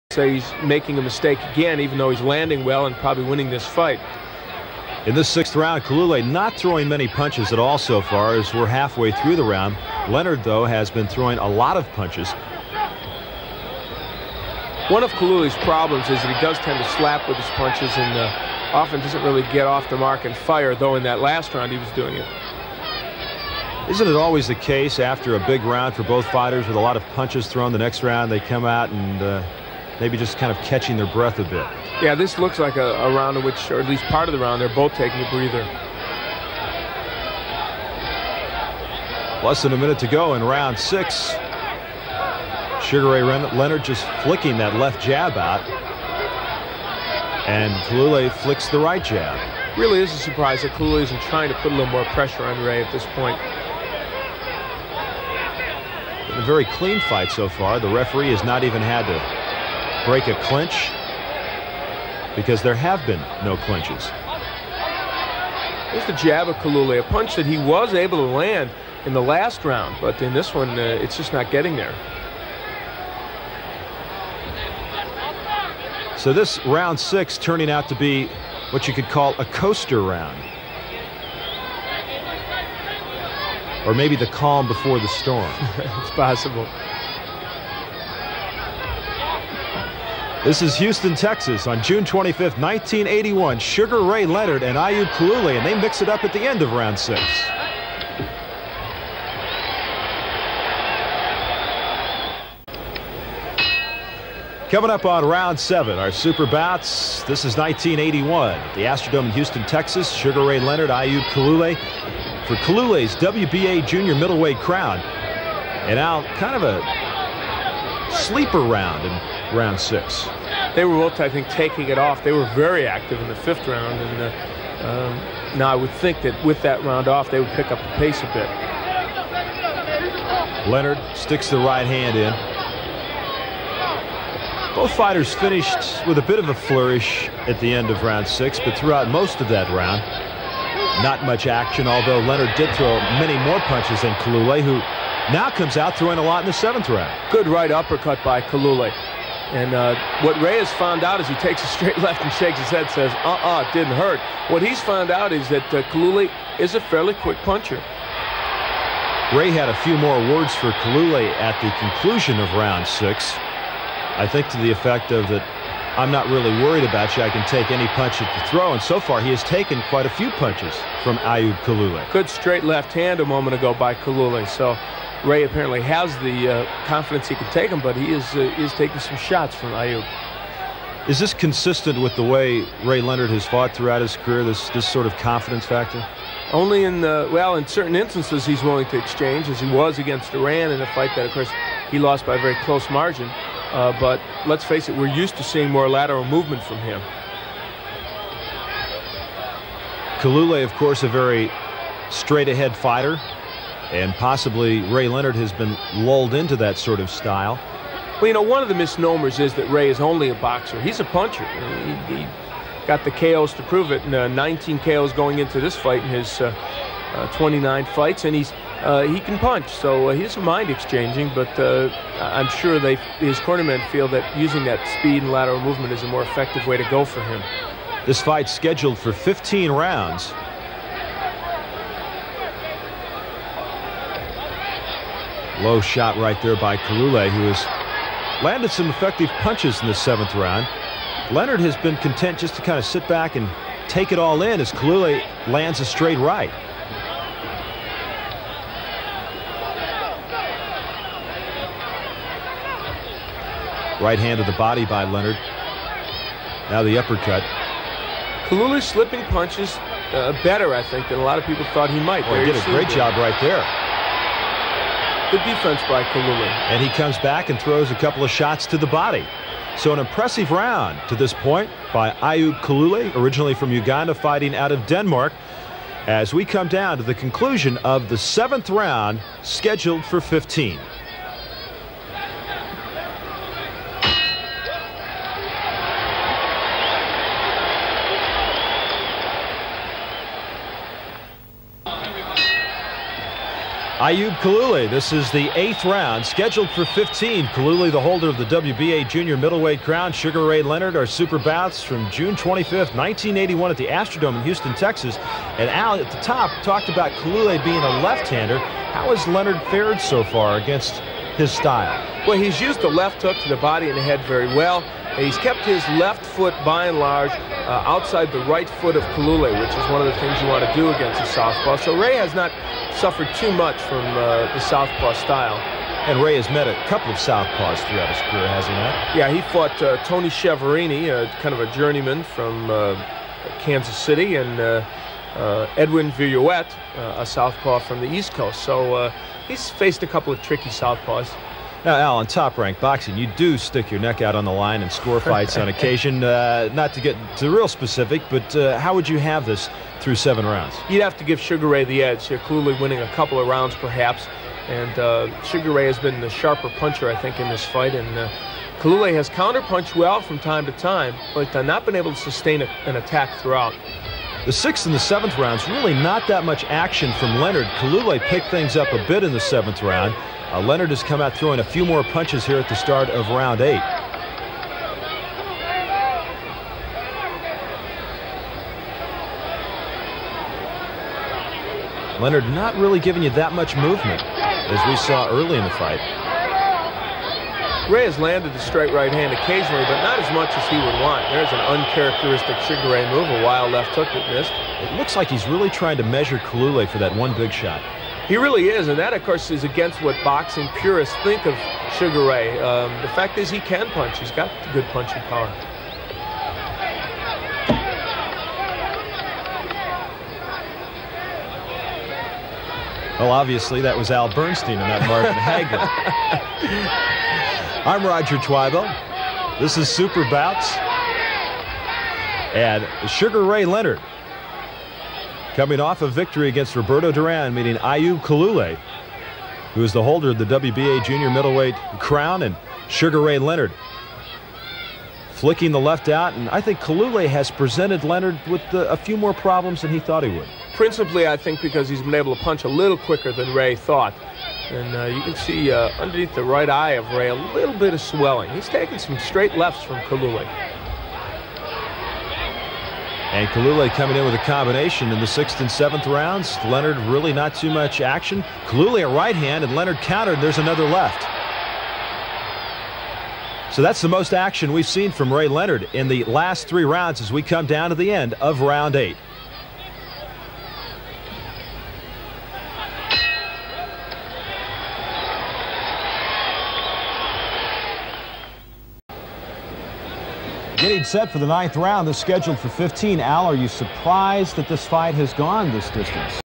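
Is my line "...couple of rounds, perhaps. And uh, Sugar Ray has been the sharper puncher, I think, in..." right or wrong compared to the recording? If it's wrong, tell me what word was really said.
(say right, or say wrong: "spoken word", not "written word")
right.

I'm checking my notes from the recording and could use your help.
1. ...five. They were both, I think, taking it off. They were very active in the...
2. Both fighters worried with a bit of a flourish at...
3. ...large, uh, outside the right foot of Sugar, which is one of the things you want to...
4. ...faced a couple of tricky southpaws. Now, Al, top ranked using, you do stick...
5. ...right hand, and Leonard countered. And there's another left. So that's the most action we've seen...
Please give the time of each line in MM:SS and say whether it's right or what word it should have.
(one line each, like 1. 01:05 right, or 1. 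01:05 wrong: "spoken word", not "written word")
1. 01:59 wrong: "six", not "five"
2. 02:14 wrong: "finished", not "worried"
3. 05:16 wrong: "Kalule", not "Sugar"
4. 05:39 wrong: "boxing", not "using"
5. 07:39 right.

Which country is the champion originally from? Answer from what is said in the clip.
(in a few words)
Uganda.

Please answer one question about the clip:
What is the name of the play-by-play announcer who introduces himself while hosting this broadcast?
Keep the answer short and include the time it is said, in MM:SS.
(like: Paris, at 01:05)
Roger Twibell, at 06:58.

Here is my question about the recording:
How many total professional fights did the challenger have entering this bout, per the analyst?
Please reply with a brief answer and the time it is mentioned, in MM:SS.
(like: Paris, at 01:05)
29, at 03:37.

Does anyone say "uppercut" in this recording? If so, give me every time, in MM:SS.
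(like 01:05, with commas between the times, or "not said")
02:27, 04:16.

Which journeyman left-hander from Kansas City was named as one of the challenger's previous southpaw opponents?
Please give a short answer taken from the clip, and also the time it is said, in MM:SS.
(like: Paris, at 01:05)
Tony Chiaverini, at 05:30.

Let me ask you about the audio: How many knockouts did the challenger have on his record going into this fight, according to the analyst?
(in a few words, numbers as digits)
19.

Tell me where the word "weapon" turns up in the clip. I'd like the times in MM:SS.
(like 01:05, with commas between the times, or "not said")
not said.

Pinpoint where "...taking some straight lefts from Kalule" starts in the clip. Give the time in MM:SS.
07:28.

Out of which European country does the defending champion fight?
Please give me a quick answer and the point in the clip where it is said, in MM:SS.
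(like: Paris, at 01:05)
Denmark, at 04:34.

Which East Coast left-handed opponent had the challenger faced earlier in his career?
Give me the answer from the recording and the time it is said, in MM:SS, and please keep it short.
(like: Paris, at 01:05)
Edwin Viruet, at 05:35.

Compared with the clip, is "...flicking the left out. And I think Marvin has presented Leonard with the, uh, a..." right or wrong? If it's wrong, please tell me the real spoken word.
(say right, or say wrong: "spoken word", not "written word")
wrong: "Kalule", not "Marvin".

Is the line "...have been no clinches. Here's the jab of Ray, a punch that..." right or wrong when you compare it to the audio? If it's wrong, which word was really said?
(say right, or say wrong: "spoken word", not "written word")
wrong: "Kalule", not "Ray".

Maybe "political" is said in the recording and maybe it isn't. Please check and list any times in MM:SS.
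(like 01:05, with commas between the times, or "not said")
not said.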